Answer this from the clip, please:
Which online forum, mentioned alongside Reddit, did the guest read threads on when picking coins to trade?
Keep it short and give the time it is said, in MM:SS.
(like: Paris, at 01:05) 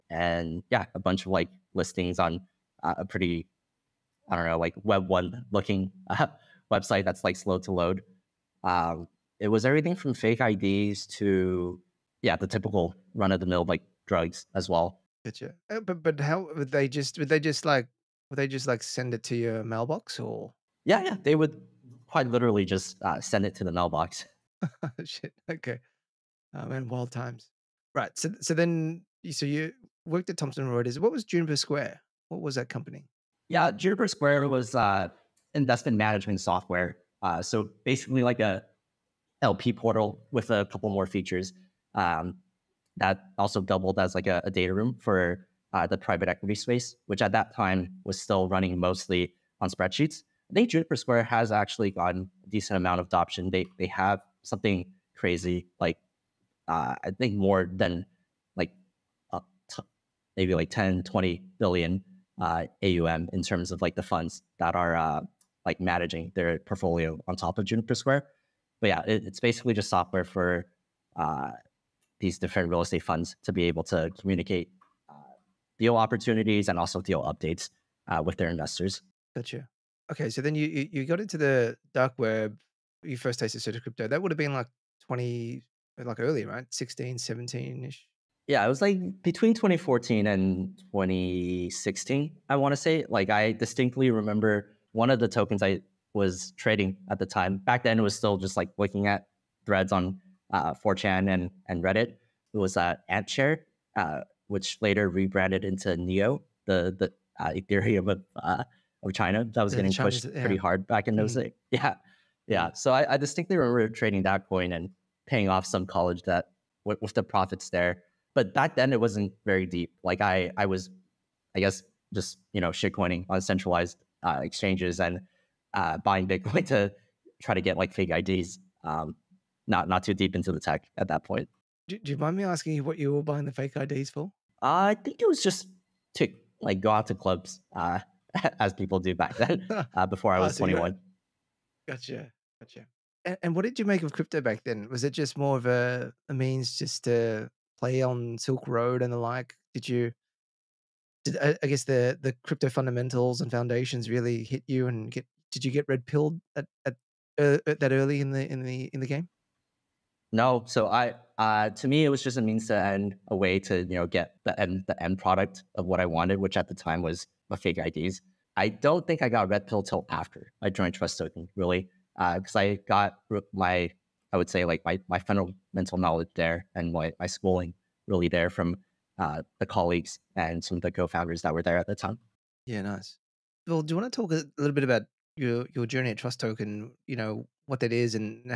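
4chan, at 01:40.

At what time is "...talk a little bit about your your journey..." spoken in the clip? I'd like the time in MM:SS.
03:04.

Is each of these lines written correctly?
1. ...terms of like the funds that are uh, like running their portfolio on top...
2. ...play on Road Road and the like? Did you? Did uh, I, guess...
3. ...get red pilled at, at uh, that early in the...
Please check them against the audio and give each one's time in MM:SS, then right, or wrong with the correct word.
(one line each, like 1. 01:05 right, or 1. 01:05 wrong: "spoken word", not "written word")
1. 01:03 wrong: "managing", not "running"
2. 02:27 wrong: "Silk", not "Road"
3. 02:35 right.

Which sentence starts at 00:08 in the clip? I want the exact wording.
Um, it was everything from fake IDs to yeah, the typical run of the mill like drugs as well.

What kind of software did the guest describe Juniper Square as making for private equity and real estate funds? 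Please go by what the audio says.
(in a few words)
Investment management software.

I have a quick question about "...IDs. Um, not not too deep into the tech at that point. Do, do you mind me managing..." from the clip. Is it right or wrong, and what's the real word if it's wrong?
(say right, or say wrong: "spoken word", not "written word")
wrong: "asking", not "managing".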